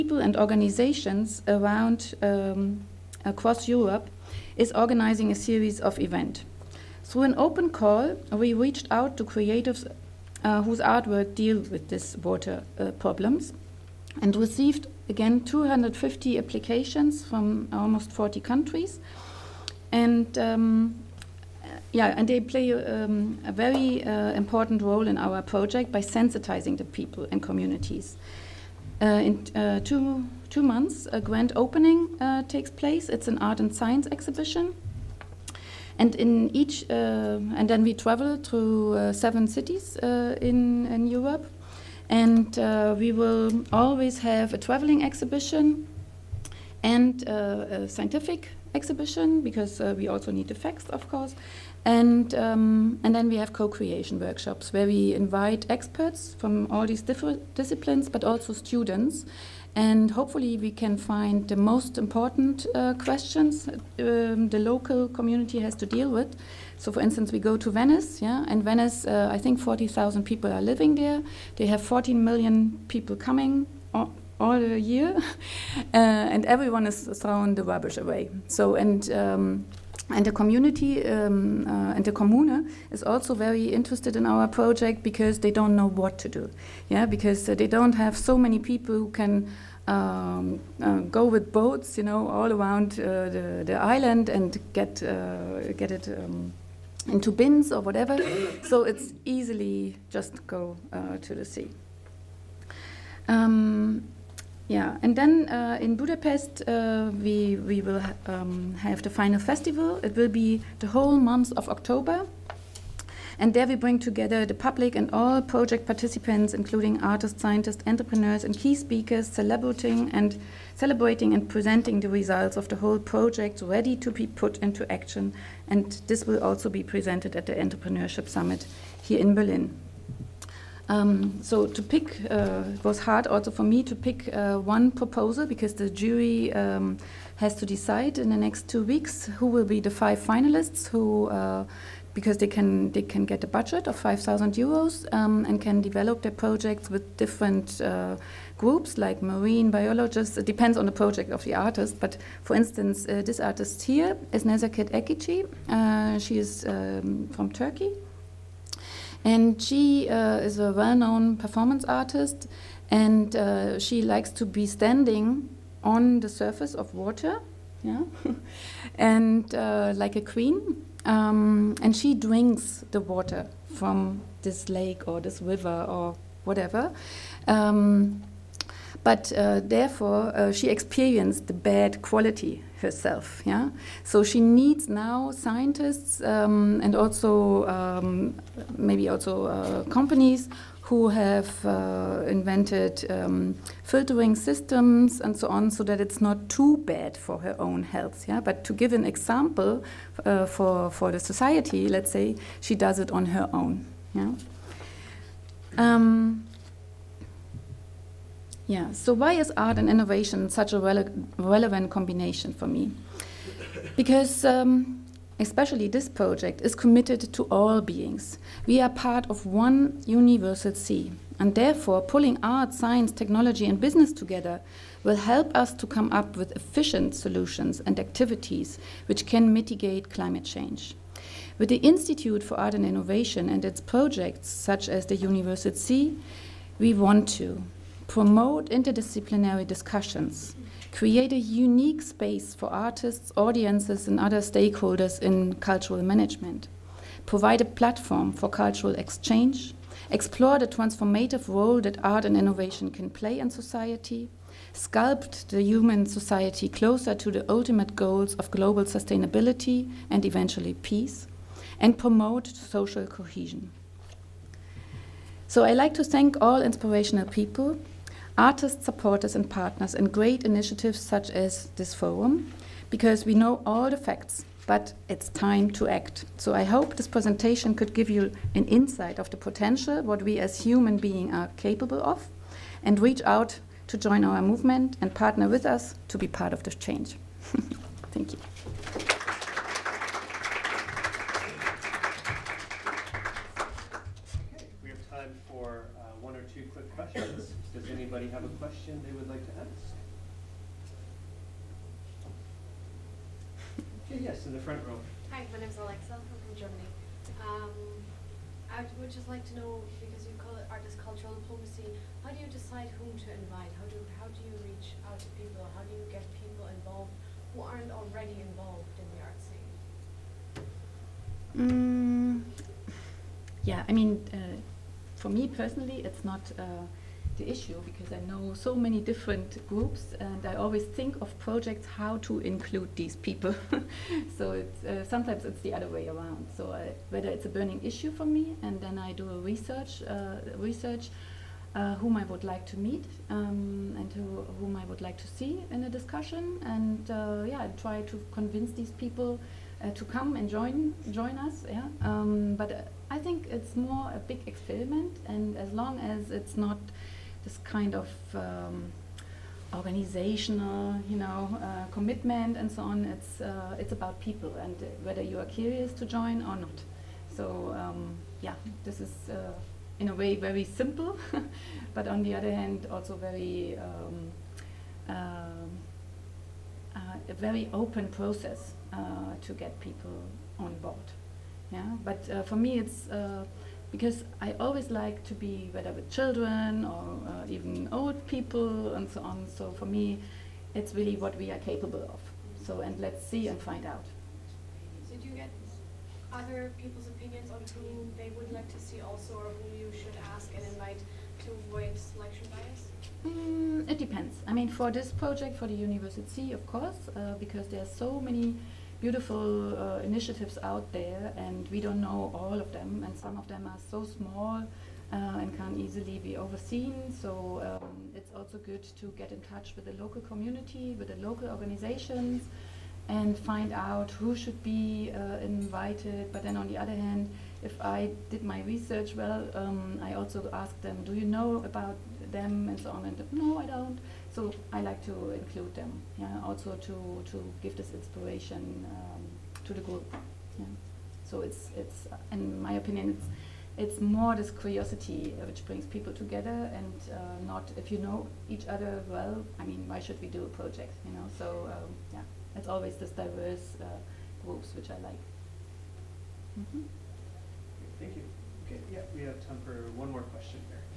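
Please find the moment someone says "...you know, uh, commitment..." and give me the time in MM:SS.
06:01.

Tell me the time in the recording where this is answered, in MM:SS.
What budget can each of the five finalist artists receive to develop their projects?
02:23.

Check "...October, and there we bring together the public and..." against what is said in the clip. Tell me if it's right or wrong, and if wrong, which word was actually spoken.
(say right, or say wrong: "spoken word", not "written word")
right.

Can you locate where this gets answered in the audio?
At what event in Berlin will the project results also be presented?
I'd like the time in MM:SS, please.
02:07.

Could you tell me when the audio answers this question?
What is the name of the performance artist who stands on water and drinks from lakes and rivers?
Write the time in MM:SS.
02:34.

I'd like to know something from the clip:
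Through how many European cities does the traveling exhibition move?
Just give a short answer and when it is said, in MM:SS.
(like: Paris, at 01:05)
7, at 00:39.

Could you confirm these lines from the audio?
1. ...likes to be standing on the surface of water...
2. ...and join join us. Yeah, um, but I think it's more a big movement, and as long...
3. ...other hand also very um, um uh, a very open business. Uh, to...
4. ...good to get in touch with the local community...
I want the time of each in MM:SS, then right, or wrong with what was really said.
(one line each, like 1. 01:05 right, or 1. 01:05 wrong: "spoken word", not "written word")
1. 02:44 right
2. 05:50 wrong: "experiment", not "movement"
3. 06:12 wrong: "process", not "business"
4. 06:58 right.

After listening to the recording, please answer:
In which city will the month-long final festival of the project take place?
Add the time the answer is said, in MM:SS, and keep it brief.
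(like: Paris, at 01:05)
Budapest, at 01:45.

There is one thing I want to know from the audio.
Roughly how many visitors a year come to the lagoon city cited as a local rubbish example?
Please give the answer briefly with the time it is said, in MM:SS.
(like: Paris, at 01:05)
14 million, at 01:11.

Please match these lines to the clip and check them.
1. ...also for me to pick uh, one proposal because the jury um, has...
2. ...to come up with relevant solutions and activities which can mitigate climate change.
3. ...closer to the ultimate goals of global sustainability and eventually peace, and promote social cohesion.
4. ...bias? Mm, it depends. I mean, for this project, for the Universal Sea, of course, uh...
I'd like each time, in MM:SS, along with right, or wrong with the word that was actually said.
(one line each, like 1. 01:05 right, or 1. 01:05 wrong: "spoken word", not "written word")
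1. 02:13 right
2. 03:45 wrong: "efficient", not "relevant"
3. 04:16 right
4. 06:42 right.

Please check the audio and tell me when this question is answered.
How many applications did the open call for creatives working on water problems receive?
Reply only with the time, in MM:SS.
00:15.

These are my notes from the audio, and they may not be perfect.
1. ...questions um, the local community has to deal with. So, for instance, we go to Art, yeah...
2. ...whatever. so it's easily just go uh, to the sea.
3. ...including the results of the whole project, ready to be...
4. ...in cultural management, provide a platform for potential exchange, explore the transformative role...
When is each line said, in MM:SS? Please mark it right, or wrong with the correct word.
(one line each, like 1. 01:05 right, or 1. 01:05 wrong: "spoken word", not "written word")
1. 01:02 wrong: "Venice", not "Art"
2. 01:37 right
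3. 02:01 wrong: "presenting", not "including"
4. 04:05 wrong: "cultural", not "potential".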